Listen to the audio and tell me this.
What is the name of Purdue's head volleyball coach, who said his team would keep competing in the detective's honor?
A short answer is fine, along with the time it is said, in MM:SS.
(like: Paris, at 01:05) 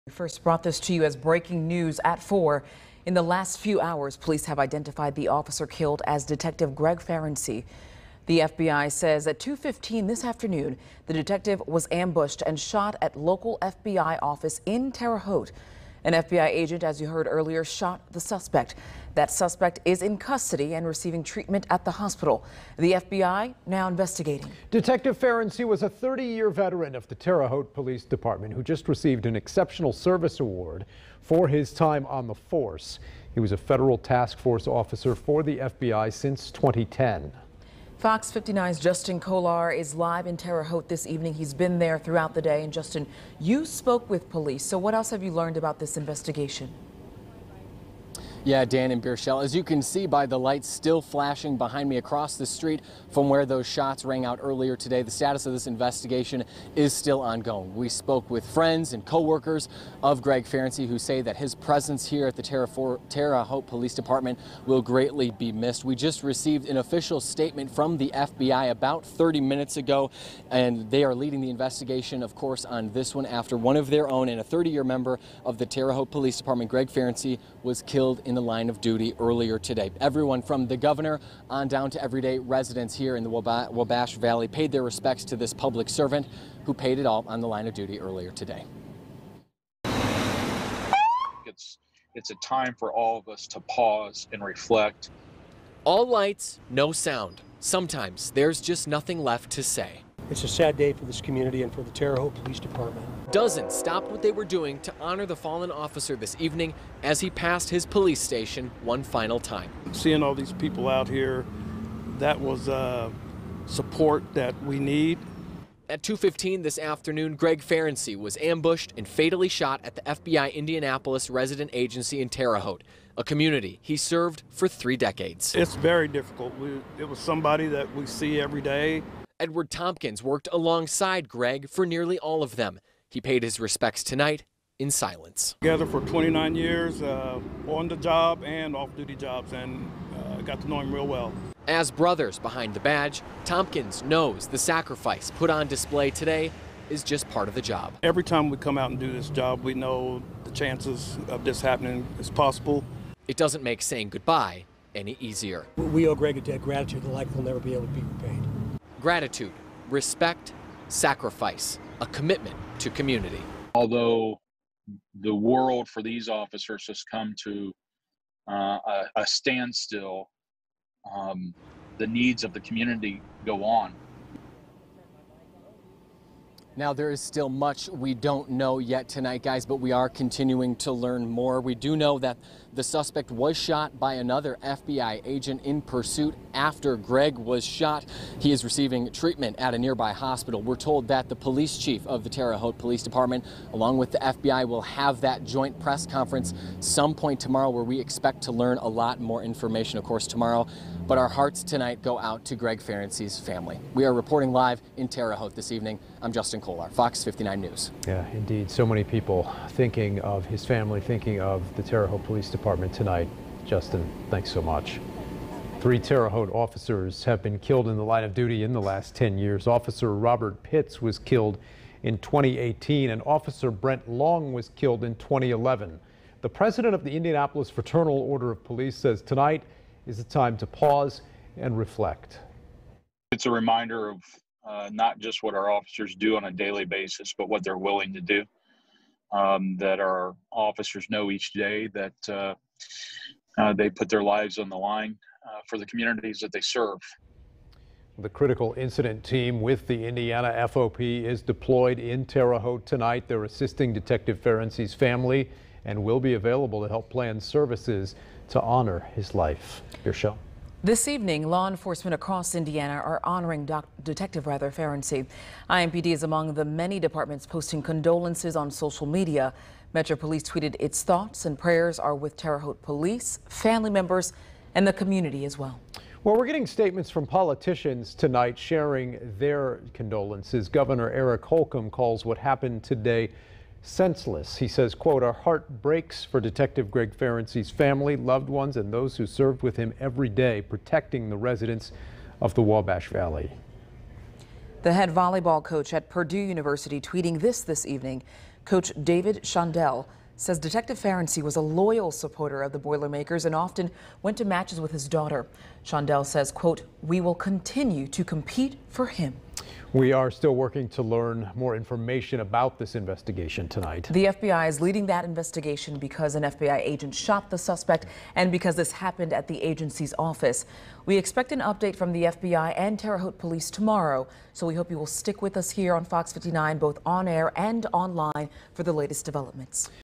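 David Shondell, at 04:59.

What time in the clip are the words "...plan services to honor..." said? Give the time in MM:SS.
04:17.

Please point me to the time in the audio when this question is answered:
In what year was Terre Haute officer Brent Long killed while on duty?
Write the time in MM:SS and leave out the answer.
03:45.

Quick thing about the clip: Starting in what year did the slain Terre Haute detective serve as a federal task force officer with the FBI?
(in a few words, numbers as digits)
2010.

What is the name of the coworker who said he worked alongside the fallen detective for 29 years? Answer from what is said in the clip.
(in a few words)
Edward Tompkins.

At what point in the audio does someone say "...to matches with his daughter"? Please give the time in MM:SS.
05:04.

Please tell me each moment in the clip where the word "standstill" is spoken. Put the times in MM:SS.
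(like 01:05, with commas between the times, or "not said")
02:49.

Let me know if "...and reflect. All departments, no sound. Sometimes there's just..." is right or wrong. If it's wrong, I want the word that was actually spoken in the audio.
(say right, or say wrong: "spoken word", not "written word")
wrong: "lights", not "departments".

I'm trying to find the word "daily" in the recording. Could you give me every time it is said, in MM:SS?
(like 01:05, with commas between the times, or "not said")
03:56.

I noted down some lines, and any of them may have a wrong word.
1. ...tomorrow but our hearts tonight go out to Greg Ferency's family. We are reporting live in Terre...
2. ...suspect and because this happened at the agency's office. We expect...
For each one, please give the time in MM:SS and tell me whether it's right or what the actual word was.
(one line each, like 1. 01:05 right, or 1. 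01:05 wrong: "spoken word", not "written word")
1. 03:20 right
2. 05:17 right.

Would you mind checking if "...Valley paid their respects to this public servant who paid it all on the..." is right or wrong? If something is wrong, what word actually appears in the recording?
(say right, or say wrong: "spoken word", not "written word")
right.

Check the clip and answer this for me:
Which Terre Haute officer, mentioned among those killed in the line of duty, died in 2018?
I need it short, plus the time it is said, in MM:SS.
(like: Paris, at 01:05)
Robert Pitts, at 03:40.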